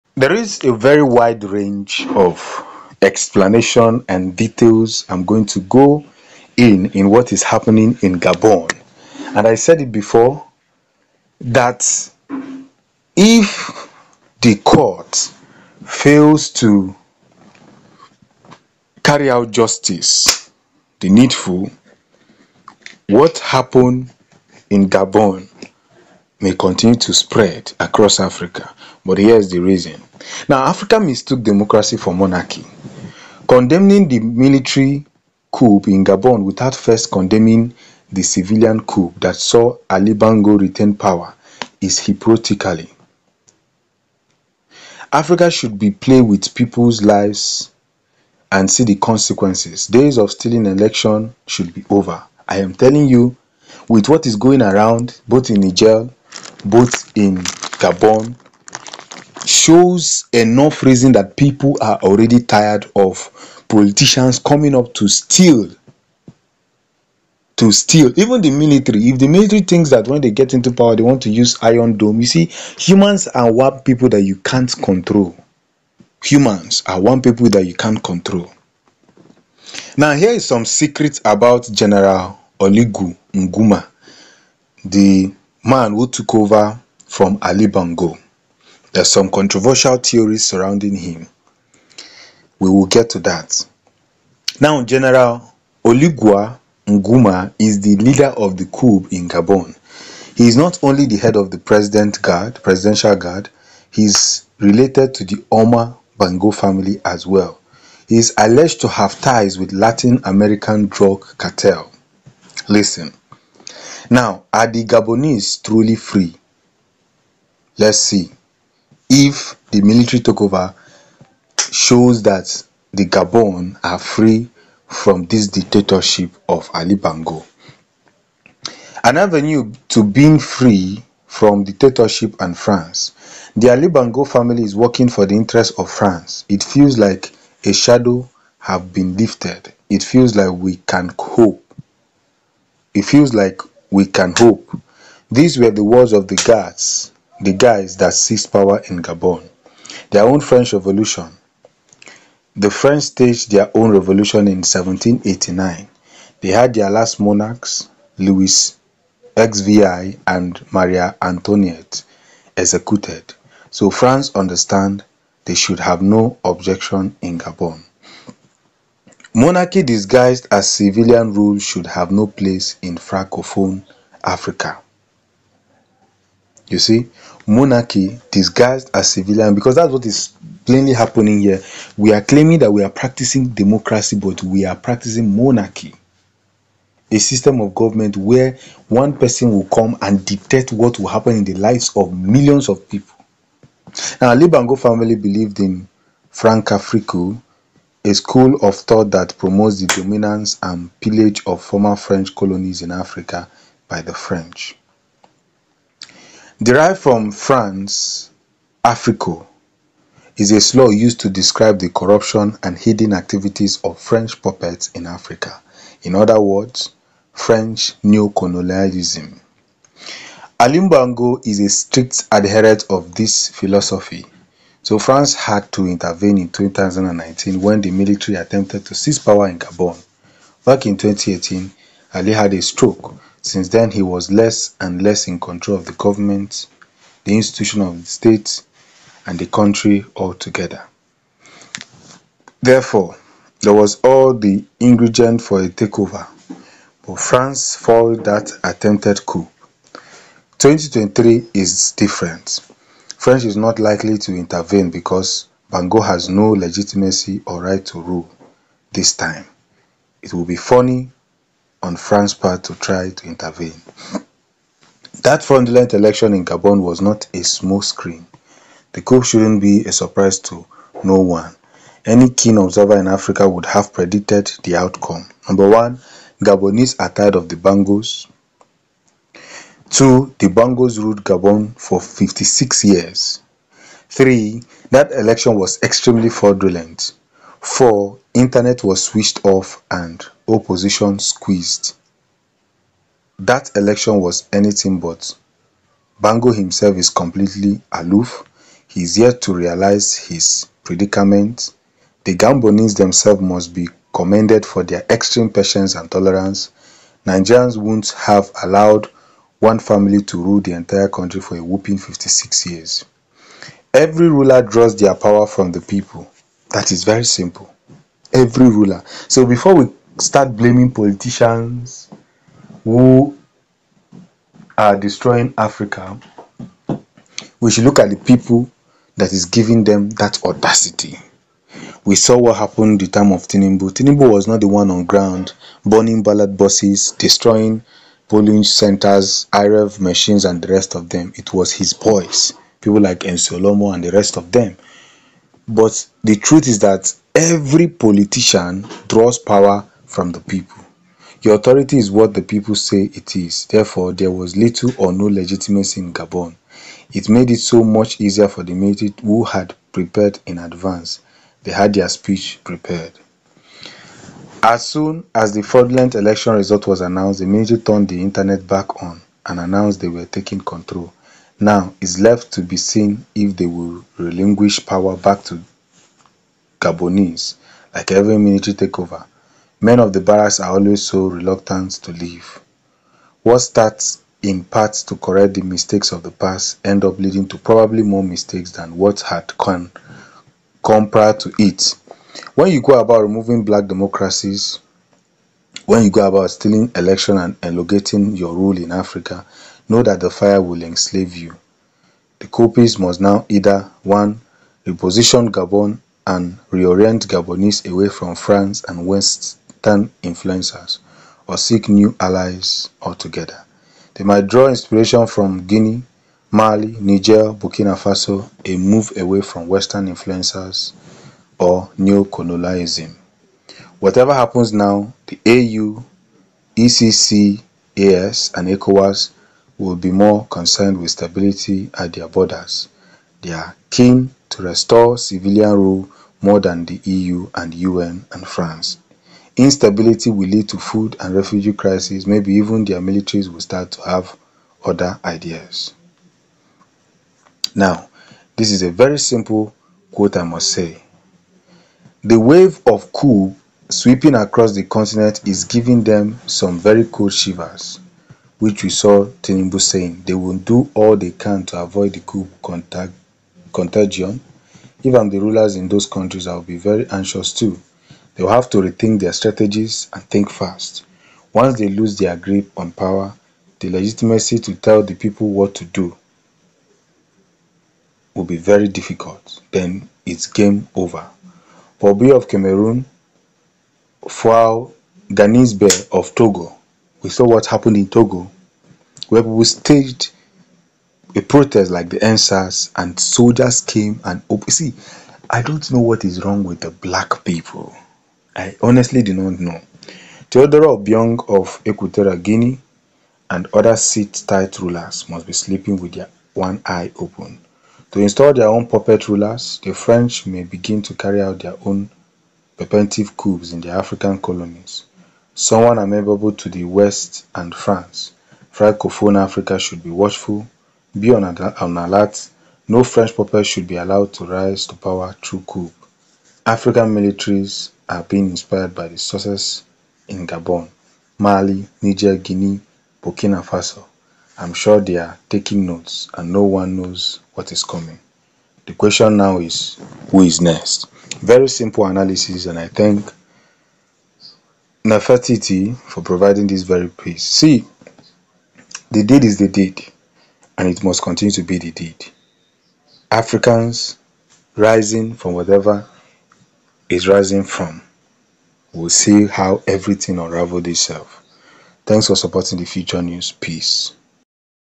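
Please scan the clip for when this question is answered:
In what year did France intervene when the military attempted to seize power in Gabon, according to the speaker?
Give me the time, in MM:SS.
03:46.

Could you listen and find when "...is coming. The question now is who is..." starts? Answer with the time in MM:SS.
08:57.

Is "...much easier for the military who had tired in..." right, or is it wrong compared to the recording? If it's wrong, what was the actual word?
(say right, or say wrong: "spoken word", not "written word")
wrong: "prepared", not "tired".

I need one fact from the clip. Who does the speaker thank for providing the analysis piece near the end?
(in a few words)
Nefertiti.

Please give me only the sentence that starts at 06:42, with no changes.
The Copies must now either 1.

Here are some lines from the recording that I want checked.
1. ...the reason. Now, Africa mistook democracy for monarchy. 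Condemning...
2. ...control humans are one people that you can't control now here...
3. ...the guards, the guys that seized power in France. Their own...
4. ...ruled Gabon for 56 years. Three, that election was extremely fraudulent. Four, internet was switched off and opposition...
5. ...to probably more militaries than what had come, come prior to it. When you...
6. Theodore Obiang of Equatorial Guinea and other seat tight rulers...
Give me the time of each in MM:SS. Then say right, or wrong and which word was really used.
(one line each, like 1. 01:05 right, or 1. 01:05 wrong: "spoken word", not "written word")
1. 00:29 right
2. 01:14 right
3. 02:26 wrong: "Gabon", not "France"
4. 04:40 right
5. 06:27 wrong: "mistakes", not "militaries"
6. 08:20 right.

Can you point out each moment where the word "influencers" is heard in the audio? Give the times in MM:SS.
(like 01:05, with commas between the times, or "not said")
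06:50, 07:00.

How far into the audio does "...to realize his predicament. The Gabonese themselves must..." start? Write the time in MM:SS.
04:59.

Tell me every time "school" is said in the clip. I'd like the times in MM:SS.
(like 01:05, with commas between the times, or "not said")
03:18.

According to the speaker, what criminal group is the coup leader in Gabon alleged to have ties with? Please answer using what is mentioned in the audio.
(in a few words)
Latin American drug cartel.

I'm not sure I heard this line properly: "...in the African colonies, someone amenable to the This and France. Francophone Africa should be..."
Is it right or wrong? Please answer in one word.
wrong.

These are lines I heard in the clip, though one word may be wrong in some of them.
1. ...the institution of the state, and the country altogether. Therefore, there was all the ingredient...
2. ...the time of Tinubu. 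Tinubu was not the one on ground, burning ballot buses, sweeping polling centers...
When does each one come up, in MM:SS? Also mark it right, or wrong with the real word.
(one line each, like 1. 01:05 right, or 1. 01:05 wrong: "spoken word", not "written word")
1. 03:57 right
2. 05:33 wrong: "destroying", not "sweeping".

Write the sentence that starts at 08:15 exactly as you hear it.
I don't know what is wrong with the black people.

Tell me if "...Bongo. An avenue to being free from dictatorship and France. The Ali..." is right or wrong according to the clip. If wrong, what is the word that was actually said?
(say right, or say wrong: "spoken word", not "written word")
right.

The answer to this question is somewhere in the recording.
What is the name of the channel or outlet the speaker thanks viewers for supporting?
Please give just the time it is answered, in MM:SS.
09:22.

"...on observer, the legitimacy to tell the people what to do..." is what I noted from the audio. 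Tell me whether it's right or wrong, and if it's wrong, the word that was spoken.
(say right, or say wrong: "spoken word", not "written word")
wrong: "power", not "observer".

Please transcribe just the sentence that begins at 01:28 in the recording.
There's some controversial theories surrounding him.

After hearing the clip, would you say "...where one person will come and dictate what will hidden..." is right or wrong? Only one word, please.
wrong.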